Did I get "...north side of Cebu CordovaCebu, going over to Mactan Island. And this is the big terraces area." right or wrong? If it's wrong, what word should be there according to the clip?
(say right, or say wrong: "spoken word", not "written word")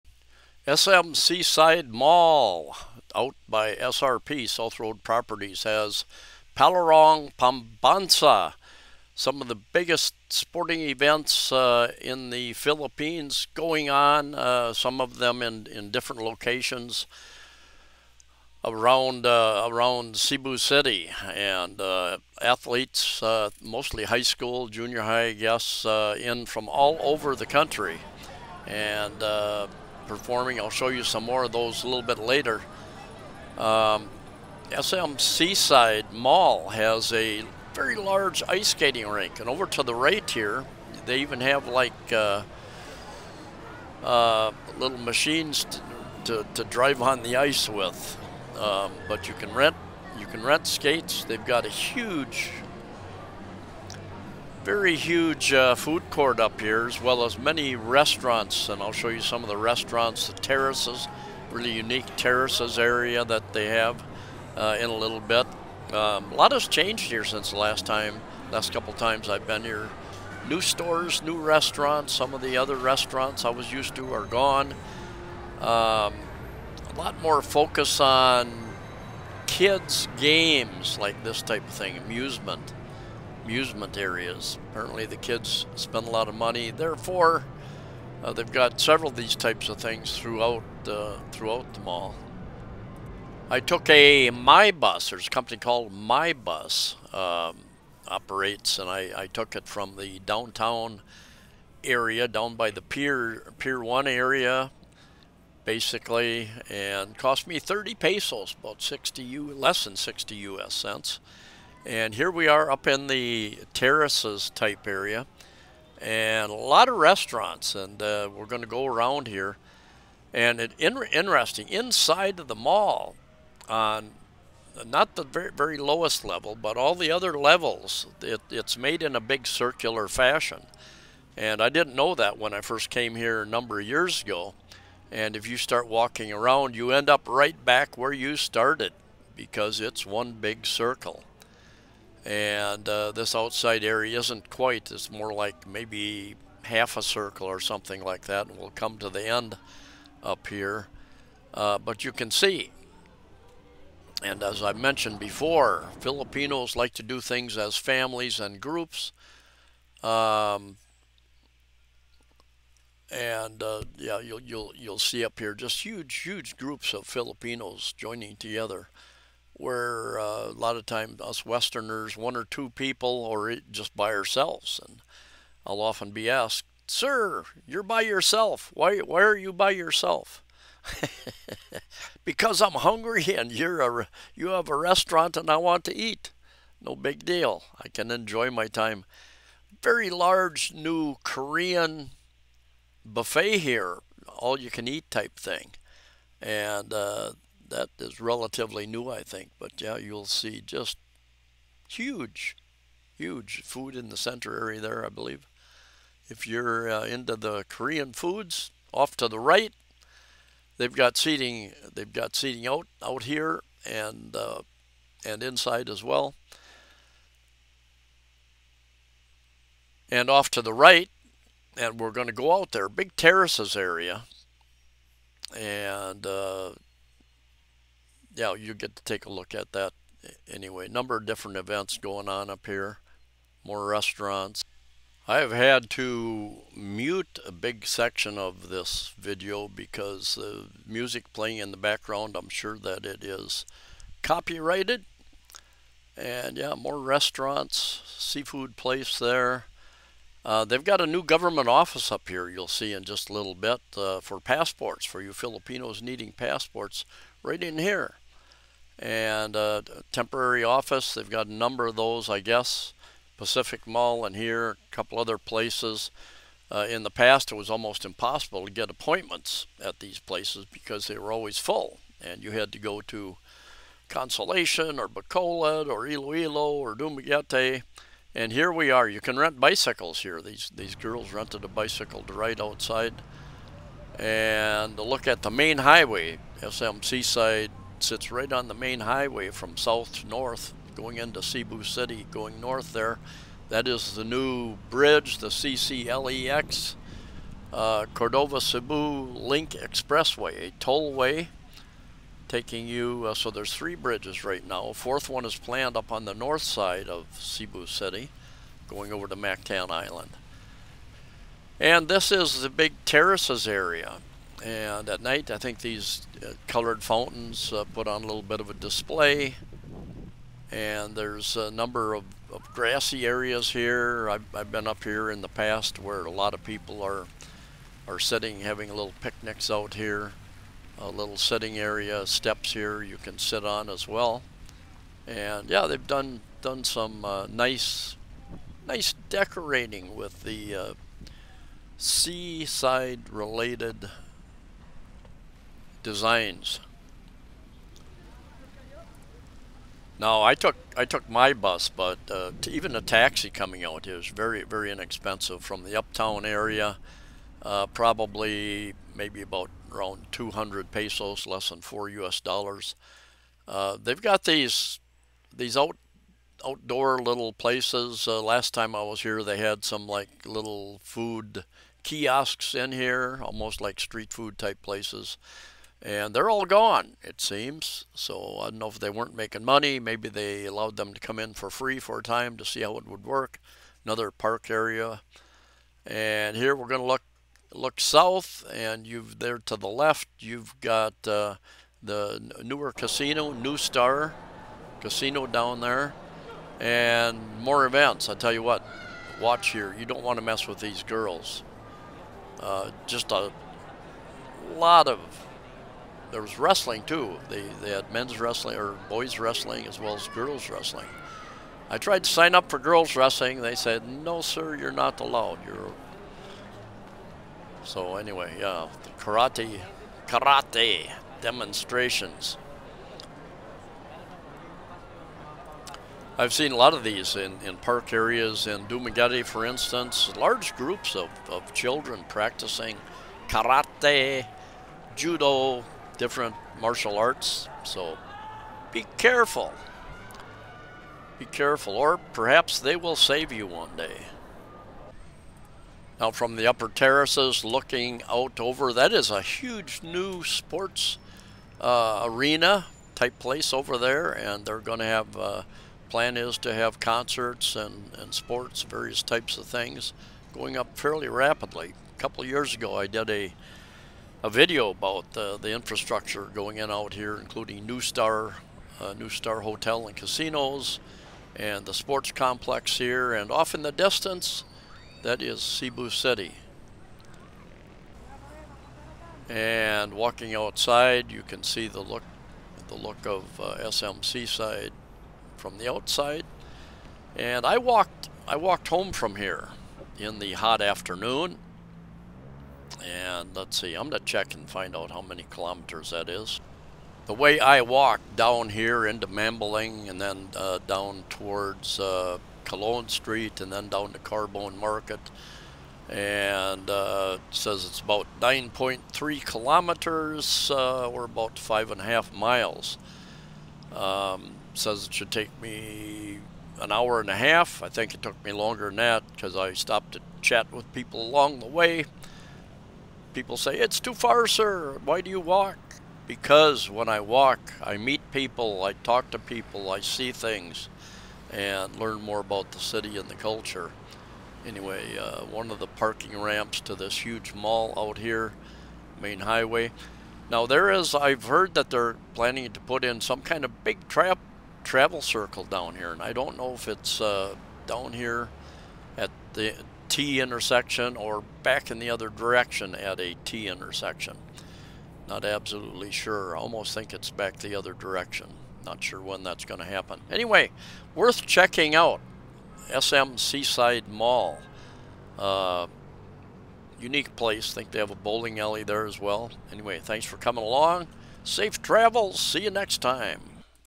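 wrong: "City", not "CordovaCebu".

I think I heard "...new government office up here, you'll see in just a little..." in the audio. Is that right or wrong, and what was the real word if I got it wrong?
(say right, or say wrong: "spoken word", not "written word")
right.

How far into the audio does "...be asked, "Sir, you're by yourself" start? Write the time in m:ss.
2:56.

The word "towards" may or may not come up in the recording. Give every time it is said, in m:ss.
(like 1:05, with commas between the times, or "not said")
8:21.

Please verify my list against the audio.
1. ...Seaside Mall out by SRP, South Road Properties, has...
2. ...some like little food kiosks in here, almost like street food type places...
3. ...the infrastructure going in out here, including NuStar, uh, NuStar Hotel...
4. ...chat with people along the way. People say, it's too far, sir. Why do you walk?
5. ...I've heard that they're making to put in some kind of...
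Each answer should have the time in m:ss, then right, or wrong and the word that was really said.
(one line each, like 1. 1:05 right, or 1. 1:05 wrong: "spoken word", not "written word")
1. 0:01 right
2. 6:09 right
3. 7:45 right
4. 8:40 right
5. 9:01 wrong: "planning", not "making".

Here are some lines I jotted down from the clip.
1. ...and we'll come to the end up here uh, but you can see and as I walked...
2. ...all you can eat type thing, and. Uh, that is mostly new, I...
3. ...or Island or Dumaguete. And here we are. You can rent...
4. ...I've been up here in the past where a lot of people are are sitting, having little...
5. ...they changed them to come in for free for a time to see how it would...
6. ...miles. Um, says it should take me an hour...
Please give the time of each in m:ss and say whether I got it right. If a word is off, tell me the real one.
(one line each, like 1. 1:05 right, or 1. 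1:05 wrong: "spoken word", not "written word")
1. 2:28 wrong: "mentioned", not "walked"
2. 3:14 wrong: "relatively", not "mostly"
3. 4:35 wrong: "Iloilo", not "Island"
4. 5:24 right
5. 6:20 wrong: "allowed", not "changed"
6. 8:32 right.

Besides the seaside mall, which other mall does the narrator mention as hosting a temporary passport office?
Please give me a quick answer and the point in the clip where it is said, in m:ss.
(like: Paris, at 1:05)
Pacific Mall, at 4:23.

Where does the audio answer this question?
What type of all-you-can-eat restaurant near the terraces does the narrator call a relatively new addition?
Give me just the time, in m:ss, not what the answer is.
3:11.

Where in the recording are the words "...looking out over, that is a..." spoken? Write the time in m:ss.
7:27.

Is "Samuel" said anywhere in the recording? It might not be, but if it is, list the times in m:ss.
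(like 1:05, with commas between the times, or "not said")
not said.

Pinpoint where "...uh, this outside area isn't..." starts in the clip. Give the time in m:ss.
2:22.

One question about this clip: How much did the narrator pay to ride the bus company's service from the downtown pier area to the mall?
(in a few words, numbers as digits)
30 pesos.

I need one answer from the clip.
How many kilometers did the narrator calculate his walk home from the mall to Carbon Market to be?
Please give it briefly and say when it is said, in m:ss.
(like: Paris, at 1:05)
9.3 kilometers, at 8:28.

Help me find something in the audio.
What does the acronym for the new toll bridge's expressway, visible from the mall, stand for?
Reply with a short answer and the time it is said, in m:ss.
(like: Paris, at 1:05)
Cordova-Cebu Link Expressway, at 4:58.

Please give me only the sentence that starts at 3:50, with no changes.
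Number of different events going on up here, more restaurants.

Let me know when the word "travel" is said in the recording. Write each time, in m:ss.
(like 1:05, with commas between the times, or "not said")
9:04, 9:31.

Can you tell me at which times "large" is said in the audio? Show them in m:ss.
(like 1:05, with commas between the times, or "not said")
0:37, 3:10, 7:10.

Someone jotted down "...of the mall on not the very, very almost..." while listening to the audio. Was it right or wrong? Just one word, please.
wrong.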